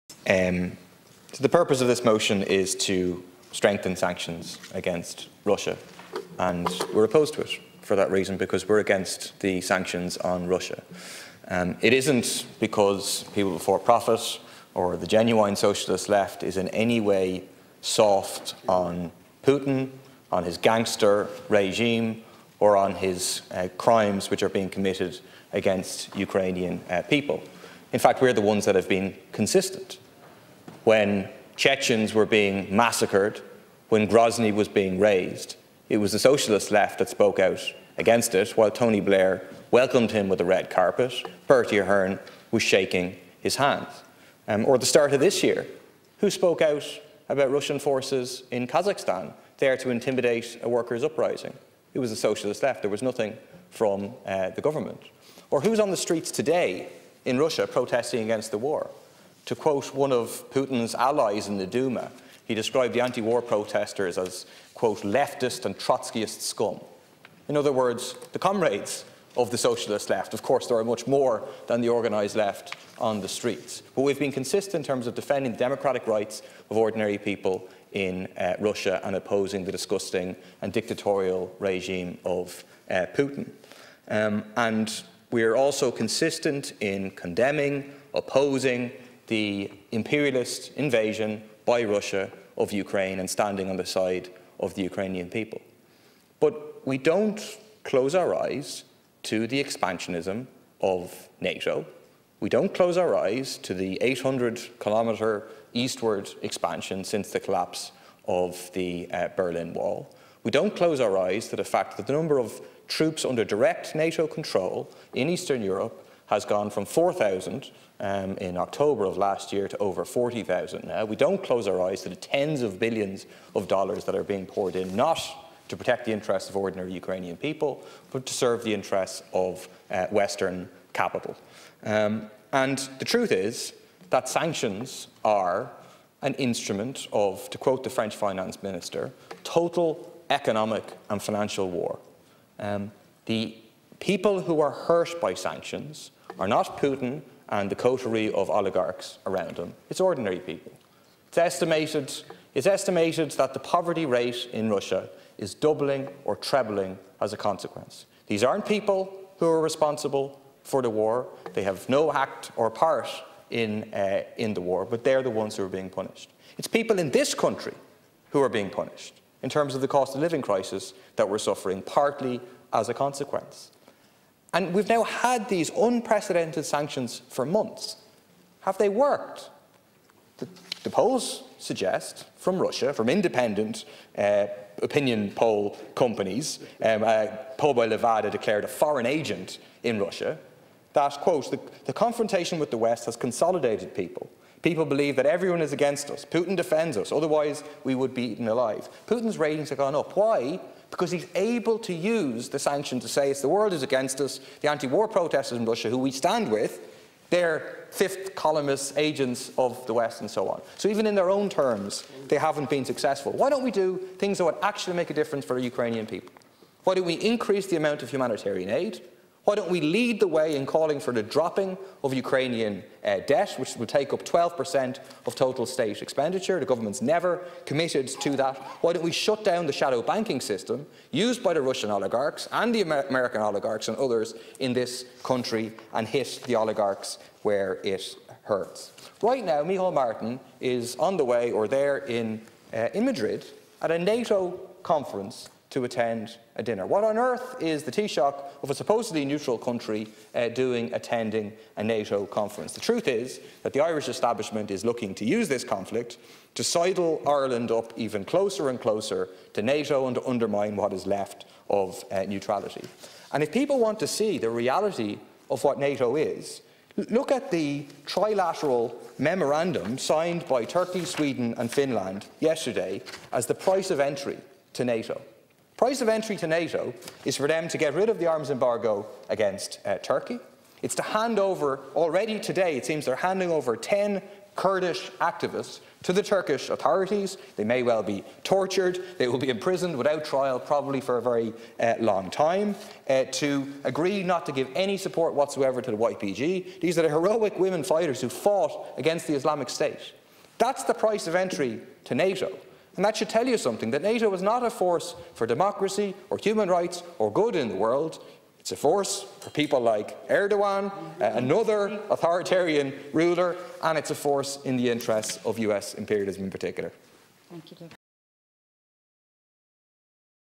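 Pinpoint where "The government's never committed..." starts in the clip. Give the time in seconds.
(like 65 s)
226 s.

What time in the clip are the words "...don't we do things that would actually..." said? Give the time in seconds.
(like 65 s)
213 s.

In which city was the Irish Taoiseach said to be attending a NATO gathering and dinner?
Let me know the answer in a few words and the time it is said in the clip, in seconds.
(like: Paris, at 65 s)
Madrid, at 243 s.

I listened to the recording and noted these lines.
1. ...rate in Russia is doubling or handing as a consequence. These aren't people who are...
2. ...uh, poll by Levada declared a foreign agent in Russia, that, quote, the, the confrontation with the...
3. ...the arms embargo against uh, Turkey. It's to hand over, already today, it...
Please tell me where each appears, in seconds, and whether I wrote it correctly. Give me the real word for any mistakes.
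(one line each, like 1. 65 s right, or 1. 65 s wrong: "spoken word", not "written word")
1. 154 s wrong: "trebling", not "handing"
2. 187 s right
3. 278 s right.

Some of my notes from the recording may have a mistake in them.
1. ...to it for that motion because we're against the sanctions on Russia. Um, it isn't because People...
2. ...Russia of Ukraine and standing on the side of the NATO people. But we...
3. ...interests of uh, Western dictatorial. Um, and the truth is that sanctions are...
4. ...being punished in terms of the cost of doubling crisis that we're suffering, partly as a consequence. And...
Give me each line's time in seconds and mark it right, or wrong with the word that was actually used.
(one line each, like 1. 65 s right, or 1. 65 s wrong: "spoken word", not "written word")
1. 7 s wrong: "reason", not "motion"
2. 91 s wrong: "Ukrainian", not "NATO"
3. 128 s wrong: "capital", not "dictatorial"
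4. 168 s wrong: "living", not "doubling".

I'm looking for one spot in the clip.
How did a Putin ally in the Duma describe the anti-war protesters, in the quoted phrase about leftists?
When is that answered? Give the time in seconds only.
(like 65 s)
65 s.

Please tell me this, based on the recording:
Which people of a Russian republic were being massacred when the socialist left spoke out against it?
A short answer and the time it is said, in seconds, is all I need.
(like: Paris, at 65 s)
Chechens, at 31 s.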